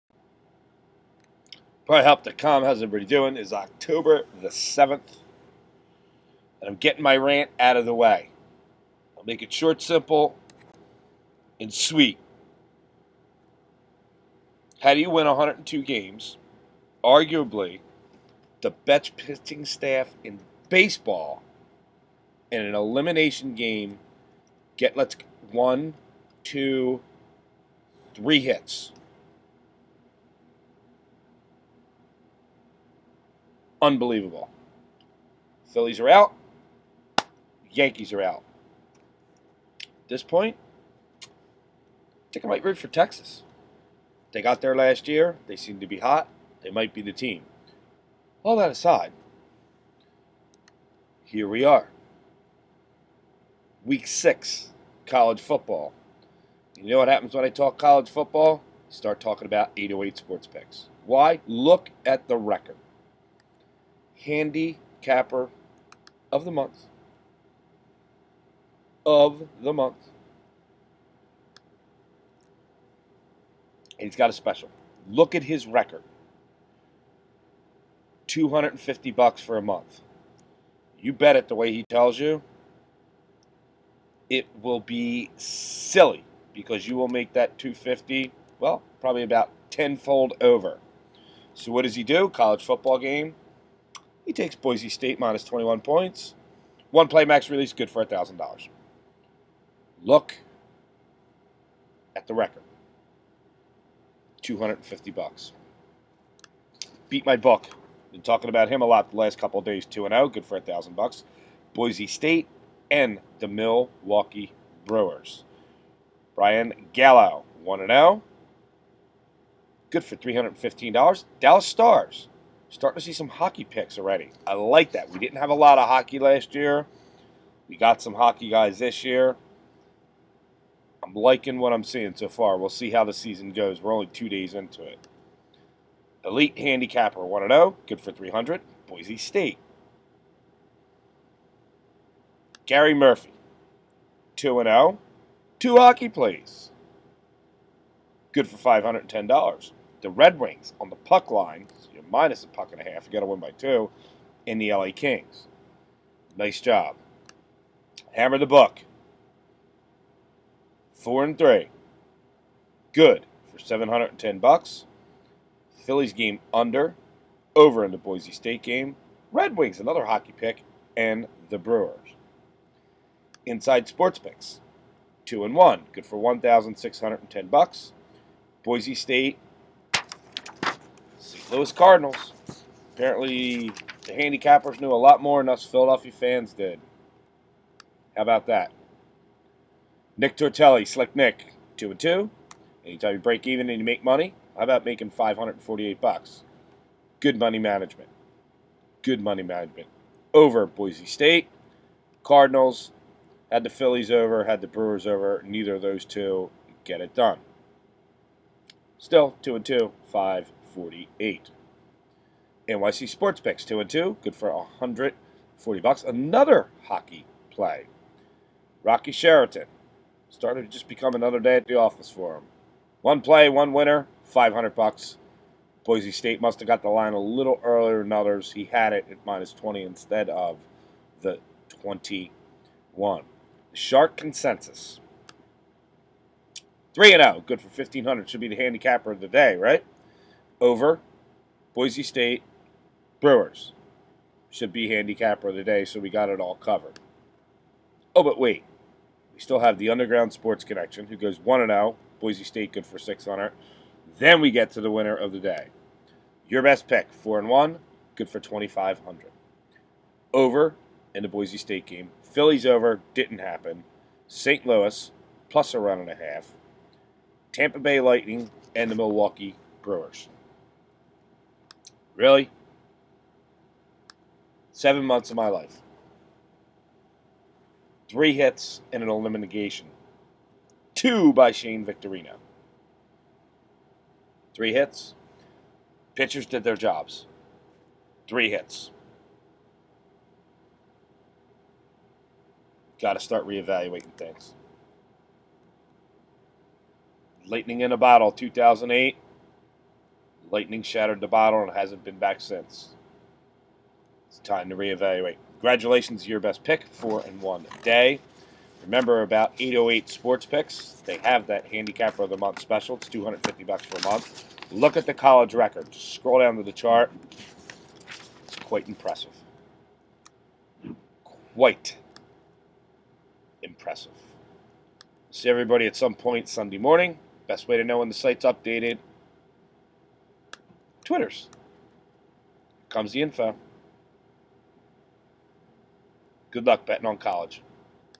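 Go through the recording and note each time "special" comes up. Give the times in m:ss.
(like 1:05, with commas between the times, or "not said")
1:14, 5:12.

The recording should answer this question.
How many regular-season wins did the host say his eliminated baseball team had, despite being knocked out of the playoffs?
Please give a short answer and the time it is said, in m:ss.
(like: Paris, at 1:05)
102, at 0:15.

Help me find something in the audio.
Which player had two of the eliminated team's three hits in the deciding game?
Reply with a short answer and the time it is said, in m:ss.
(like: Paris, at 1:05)
Shane Victorino, at 4:41.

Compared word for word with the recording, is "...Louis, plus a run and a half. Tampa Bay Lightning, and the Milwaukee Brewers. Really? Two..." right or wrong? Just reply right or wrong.
wrong.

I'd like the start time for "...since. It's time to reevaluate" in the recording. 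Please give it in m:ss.
5:02.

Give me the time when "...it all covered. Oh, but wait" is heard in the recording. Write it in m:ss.
4:06.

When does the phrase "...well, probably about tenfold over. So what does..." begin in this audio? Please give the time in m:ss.
1:28.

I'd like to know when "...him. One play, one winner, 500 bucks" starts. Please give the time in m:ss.
3:42.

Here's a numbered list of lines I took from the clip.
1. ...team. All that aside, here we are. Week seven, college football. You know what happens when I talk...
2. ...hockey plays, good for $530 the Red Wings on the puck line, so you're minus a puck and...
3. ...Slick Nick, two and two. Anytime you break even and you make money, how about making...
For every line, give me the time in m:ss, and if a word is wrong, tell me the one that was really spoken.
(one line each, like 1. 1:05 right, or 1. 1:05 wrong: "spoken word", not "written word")
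1. 0:47 wrong: "six", not "seven"
2. 2:25 wrong: "510", not "530"
3. 3:10 right.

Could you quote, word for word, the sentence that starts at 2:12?
We'll see how the season goes.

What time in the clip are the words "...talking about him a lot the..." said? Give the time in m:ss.
1:48.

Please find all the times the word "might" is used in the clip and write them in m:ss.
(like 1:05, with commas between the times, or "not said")
0:42, 0:46.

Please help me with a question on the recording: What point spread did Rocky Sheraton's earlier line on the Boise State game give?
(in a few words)
minus 20.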